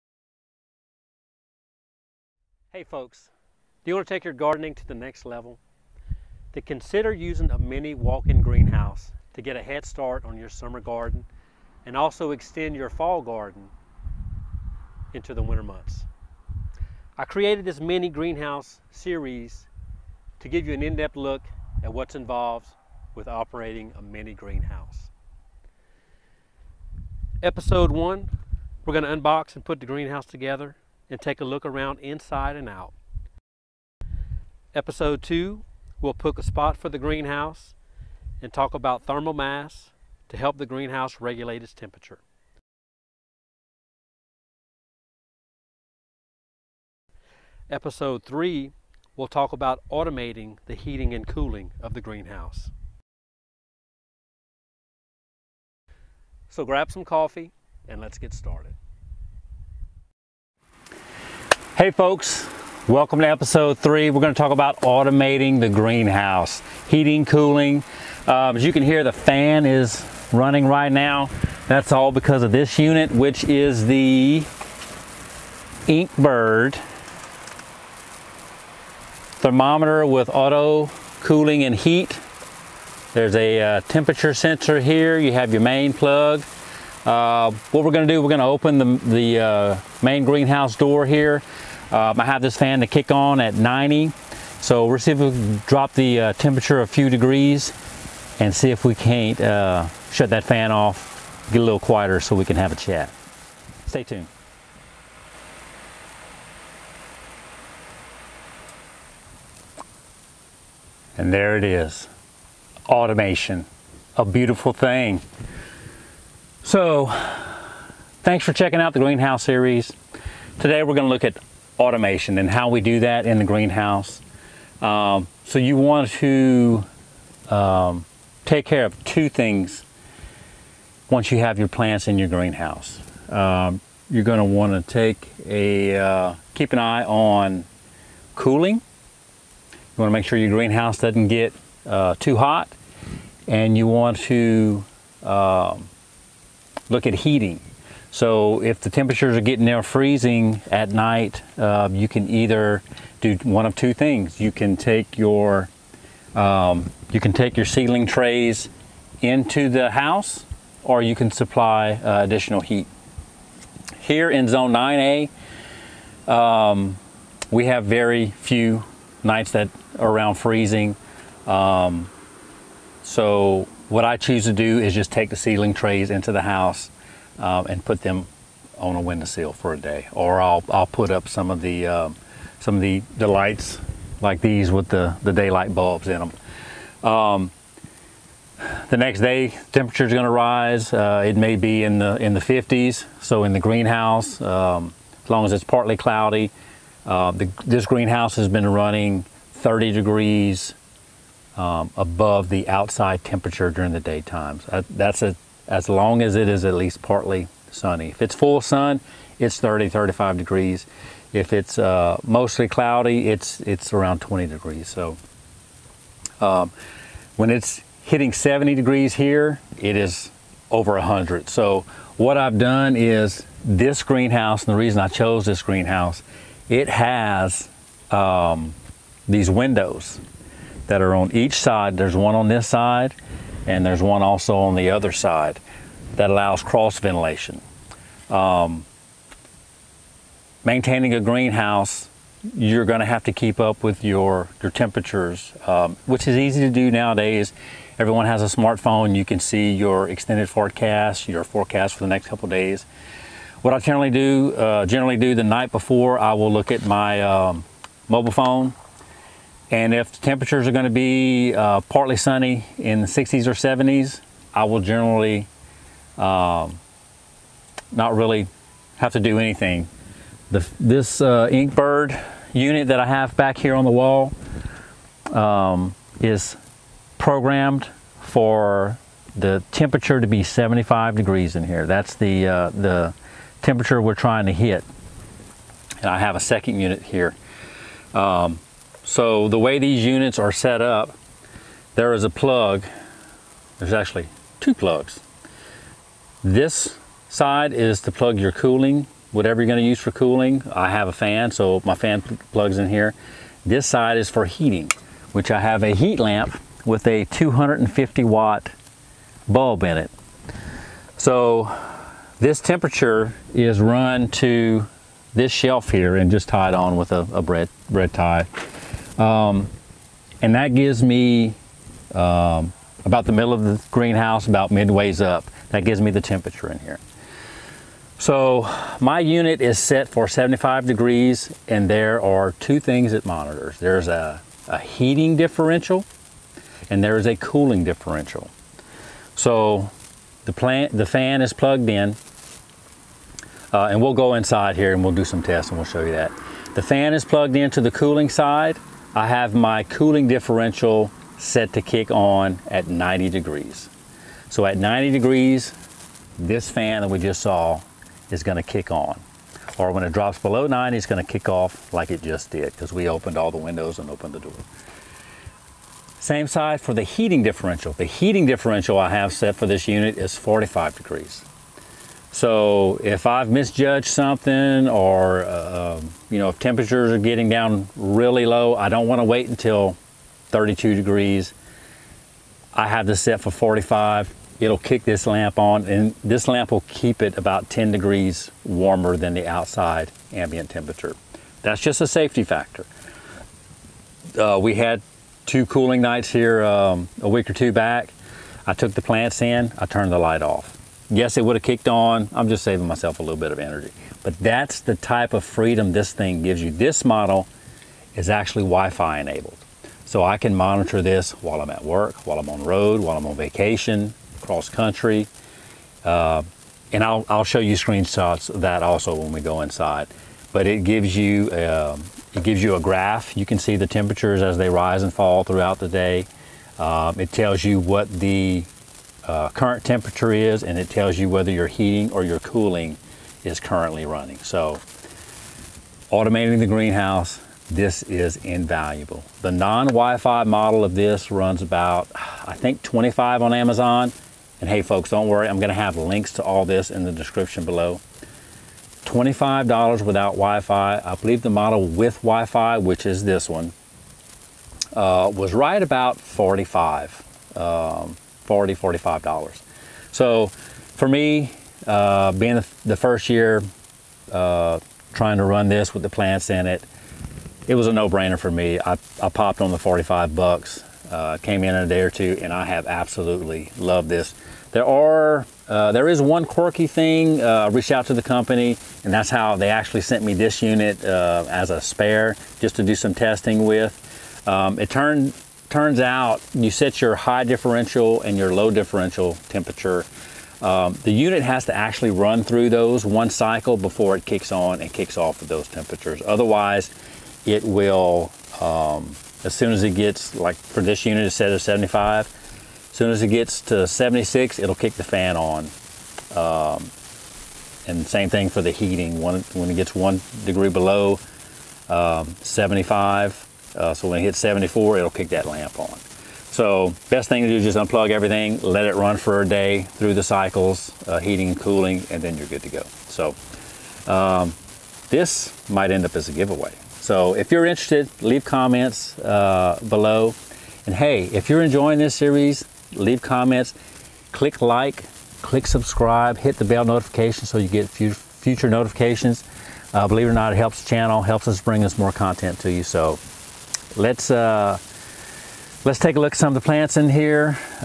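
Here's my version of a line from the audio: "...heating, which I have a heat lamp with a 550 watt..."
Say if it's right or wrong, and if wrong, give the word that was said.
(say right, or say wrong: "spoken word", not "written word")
wrong: "250", not "550".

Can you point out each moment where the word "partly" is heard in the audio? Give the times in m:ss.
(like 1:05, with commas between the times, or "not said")
3:15, 3:27, 4:21.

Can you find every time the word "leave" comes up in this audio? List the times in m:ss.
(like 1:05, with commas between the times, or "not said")
8:48, 8:52.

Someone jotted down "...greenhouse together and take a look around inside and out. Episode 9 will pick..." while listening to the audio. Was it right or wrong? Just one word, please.
wrong.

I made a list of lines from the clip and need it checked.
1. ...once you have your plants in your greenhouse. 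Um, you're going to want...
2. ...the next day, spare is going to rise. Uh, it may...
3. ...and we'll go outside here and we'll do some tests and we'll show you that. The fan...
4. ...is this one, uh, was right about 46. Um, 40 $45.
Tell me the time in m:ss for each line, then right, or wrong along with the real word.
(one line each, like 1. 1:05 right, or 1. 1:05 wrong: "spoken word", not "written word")
1. 2:11 right
2. 3:08 wrong: "temperature", not "spare"
3. 5:43 wrong: "inside", not "outside"
4. 7:33 wrong: "45", not "46".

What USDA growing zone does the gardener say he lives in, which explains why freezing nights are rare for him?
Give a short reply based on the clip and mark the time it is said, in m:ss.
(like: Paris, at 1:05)
Zone 9A, at 2:44.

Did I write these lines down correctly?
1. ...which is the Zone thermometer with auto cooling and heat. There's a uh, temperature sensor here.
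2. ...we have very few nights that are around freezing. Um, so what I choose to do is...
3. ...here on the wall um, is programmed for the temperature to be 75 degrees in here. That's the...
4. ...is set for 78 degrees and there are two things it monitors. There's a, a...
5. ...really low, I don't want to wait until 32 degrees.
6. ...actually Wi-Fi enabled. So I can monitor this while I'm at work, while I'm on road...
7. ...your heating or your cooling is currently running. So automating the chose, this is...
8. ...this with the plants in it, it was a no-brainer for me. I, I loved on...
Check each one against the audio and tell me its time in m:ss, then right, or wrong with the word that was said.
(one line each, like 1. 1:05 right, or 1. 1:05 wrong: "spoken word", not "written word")
1. 1:13 wrong: "Inkbird", not "Zone"
2. 2:47 right
3. 4:33 right
4. 5:29 wrong: "75", not "78"
5. 6:17 right
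6. 6:48 right
7. 7:11 wrong: "greenhouse", not "chose"
8. 7:45 wrong: "popped", not "loved".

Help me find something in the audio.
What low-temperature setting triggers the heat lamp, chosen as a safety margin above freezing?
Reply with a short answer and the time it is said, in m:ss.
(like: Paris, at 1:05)
45 degrees, at 6:10.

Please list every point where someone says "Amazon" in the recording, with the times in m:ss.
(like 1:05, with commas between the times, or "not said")
7:23.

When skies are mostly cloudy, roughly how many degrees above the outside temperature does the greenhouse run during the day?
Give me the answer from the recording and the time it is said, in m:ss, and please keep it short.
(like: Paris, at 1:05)
20 degrees, at 3:33.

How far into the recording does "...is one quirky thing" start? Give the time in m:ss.
7:56.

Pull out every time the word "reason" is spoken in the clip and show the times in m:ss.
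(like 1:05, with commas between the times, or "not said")
3:44.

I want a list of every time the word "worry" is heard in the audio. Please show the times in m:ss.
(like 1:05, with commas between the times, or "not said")
7:25.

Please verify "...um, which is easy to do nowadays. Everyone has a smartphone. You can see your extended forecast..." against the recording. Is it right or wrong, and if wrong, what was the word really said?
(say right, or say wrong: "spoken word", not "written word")
right.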